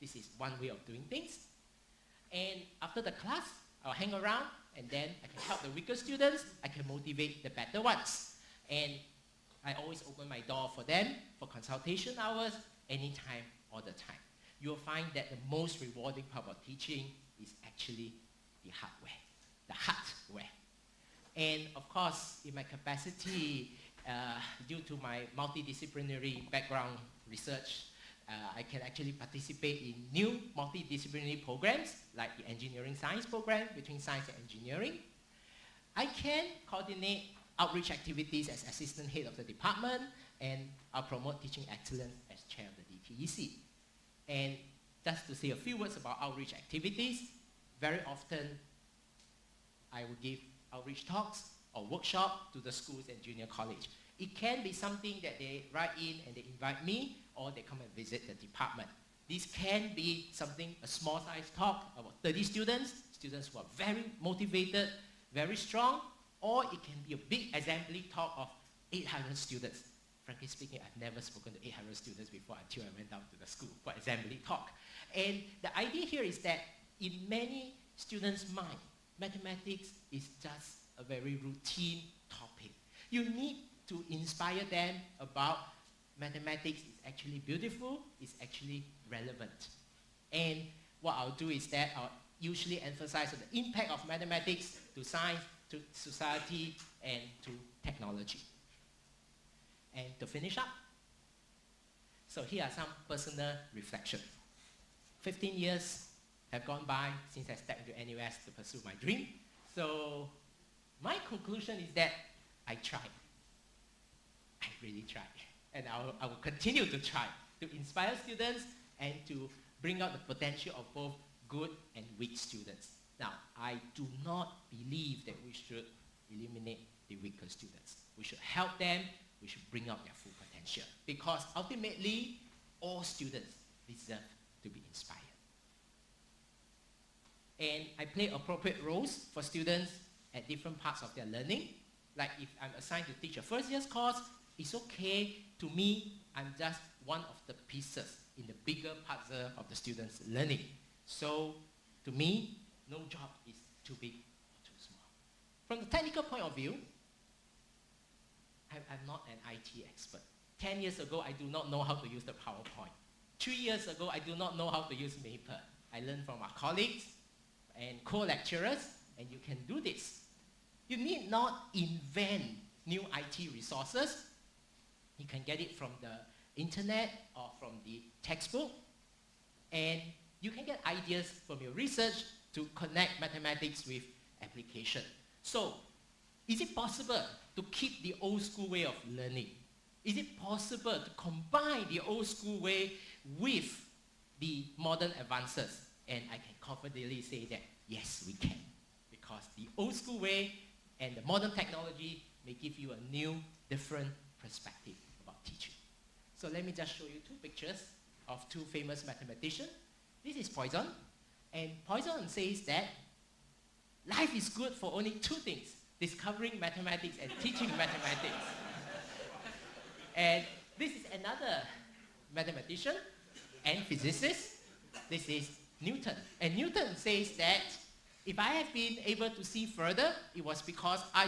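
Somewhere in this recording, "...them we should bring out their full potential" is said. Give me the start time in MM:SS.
02:08.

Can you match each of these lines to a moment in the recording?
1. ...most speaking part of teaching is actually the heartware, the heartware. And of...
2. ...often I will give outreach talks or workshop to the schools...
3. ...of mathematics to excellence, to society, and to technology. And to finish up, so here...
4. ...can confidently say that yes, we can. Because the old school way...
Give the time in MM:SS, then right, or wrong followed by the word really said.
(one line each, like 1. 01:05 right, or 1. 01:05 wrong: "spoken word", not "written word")
1. 00:15 wrong: "rewarding", not "speaking"
2. 00:48 right
3. 01:33 wrong: "science", not "excellence"
4. 03:16 right.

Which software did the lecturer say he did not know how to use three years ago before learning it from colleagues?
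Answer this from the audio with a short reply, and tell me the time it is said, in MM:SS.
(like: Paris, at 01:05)
Maple, at 02:45.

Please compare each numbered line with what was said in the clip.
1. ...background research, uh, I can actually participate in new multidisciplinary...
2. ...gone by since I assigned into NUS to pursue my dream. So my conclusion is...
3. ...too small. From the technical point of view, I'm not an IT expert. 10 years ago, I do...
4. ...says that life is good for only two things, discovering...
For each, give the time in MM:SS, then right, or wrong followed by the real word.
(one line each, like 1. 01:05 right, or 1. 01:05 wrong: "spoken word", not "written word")
1. 00:26 right
2. 01:46 wrong: "stepped", not "assigned"
3. 02:34 right
4. 03:32 right.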